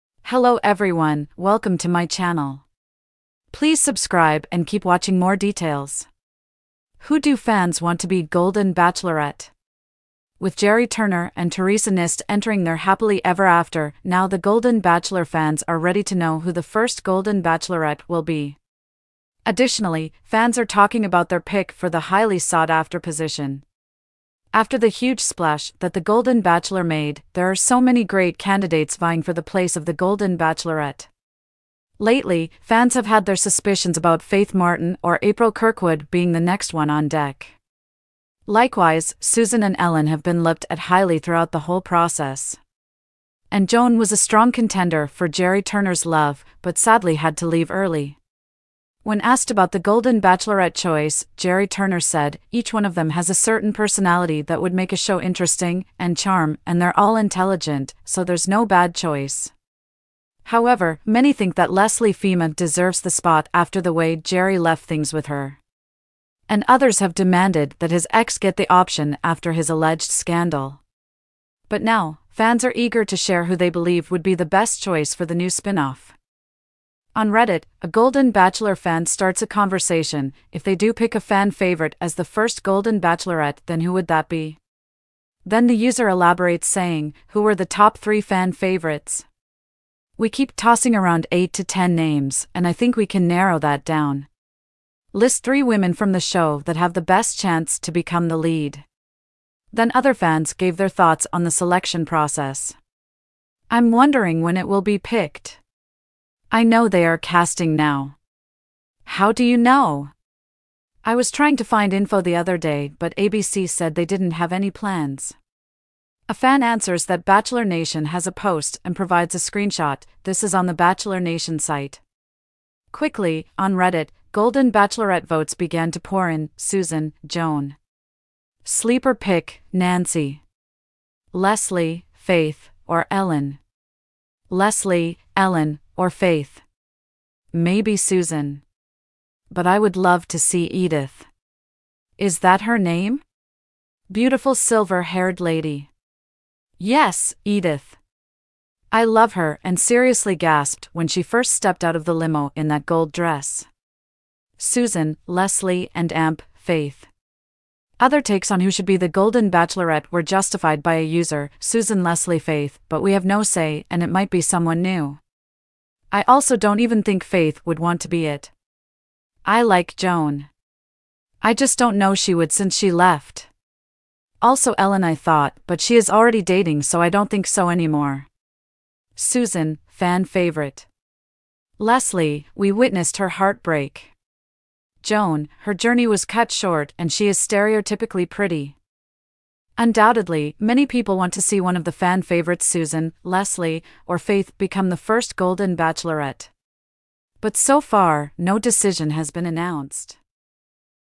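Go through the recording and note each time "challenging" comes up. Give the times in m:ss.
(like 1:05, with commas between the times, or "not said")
not said.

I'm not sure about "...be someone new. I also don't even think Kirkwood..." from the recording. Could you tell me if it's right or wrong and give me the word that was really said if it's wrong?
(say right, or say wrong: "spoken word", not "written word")
wrong: "Faith", not "Kirkwood".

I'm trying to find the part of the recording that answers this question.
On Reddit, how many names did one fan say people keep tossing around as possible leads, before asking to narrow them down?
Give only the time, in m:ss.
1:31.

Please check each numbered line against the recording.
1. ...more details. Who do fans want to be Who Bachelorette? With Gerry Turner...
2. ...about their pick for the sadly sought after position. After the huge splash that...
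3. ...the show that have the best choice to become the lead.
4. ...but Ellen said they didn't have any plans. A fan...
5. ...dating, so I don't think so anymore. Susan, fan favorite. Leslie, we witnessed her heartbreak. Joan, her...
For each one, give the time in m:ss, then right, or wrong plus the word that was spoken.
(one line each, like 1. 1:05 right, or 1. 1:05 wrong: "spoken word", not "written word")
1. 0:05 wrong: "Golden", not "Who"
2. 0:21 wrong: "highly", not "sadly"
3. 1:36 wrong: "chance", not "choice"
4. 1:52 wrong: "ABC", not "Ellen"
5. 2:56 right.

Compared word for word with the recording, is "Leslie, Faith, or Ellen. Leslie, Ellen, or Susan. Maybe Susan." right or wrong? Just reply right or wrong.
wrong.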